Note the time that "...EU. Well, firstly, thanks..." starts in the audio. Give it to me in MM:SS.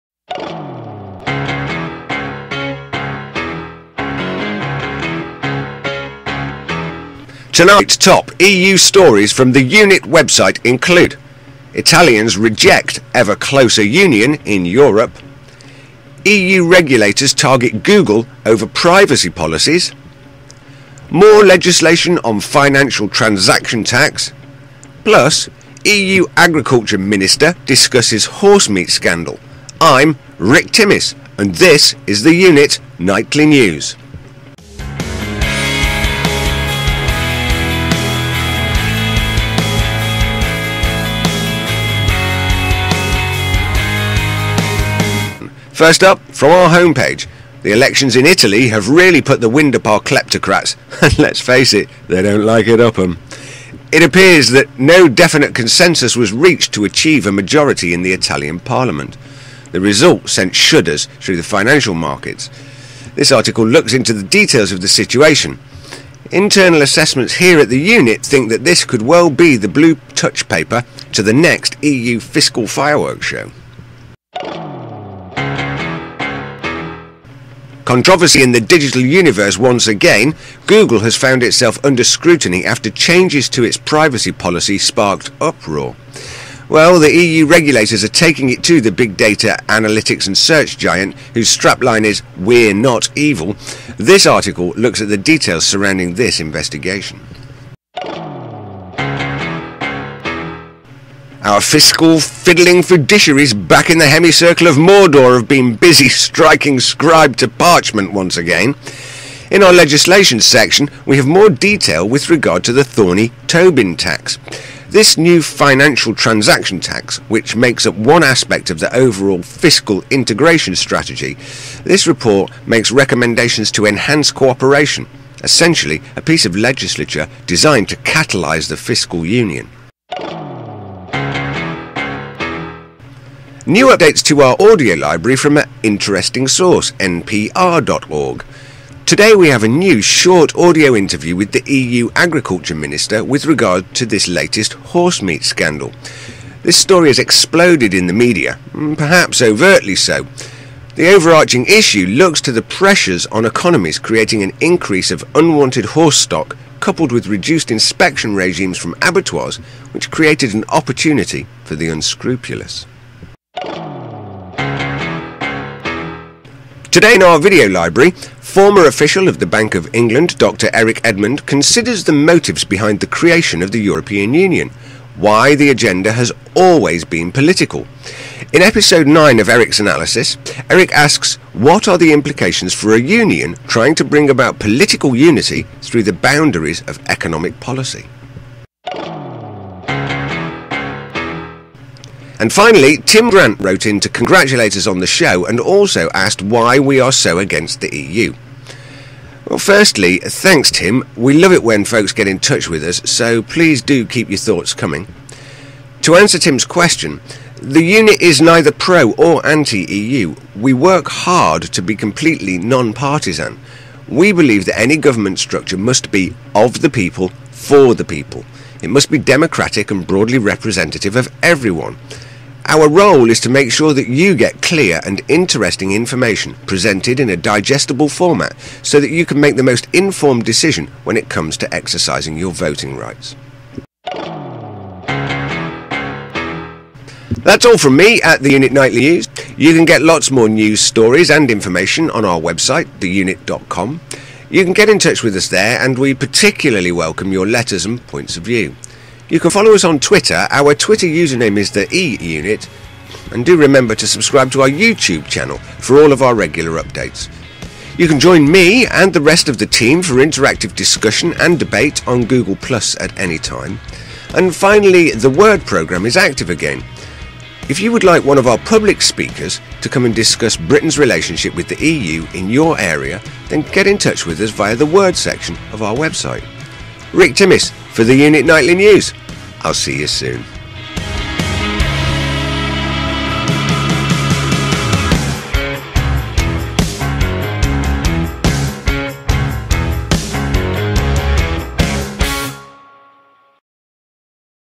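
03:17.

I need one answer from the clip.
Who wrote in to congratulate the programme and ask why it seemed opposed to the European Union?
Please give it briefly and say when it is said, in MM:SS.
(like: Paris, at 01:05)
Tim Grant, at 03:12.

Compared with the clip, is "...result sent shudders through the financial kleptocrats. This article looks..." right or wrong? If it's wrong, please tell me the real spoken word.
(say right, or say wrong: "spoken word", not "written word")
wrong: "markets", not "kleptocrats".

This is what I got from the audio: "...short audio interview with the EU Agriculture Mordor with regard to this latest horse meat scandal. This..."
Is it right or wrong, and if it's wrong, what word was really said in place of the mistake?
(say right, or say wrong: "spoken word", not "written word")
wrong: "Minister", not "Mordor".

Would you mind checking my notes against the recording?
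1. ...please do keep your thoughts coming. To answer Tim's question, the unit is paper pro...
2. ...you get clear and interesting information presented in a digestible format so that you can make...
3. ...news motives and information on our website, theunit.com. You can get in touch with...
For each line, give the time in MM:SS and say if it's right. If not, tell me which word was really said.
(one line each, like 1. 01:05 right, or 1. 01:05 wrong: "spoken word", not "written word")
1. 03:23 wrong: "neither", not "paper"
2. 03:44 right
3. 04:00 wrong: "stories", not "motives".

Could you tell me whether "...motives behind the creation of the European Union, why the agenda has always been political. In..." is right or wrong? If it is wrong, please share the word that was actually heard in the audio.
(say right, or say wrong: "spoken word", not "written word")
right.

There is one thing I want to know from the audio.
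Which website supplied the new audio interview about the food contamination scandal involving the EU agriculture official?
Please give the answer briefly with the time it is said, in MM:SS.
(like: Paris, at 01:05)
npr.org, at 02:16.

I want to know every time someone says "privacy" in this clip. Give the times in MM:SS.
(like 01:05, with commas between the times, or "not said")
00:18, 01:23.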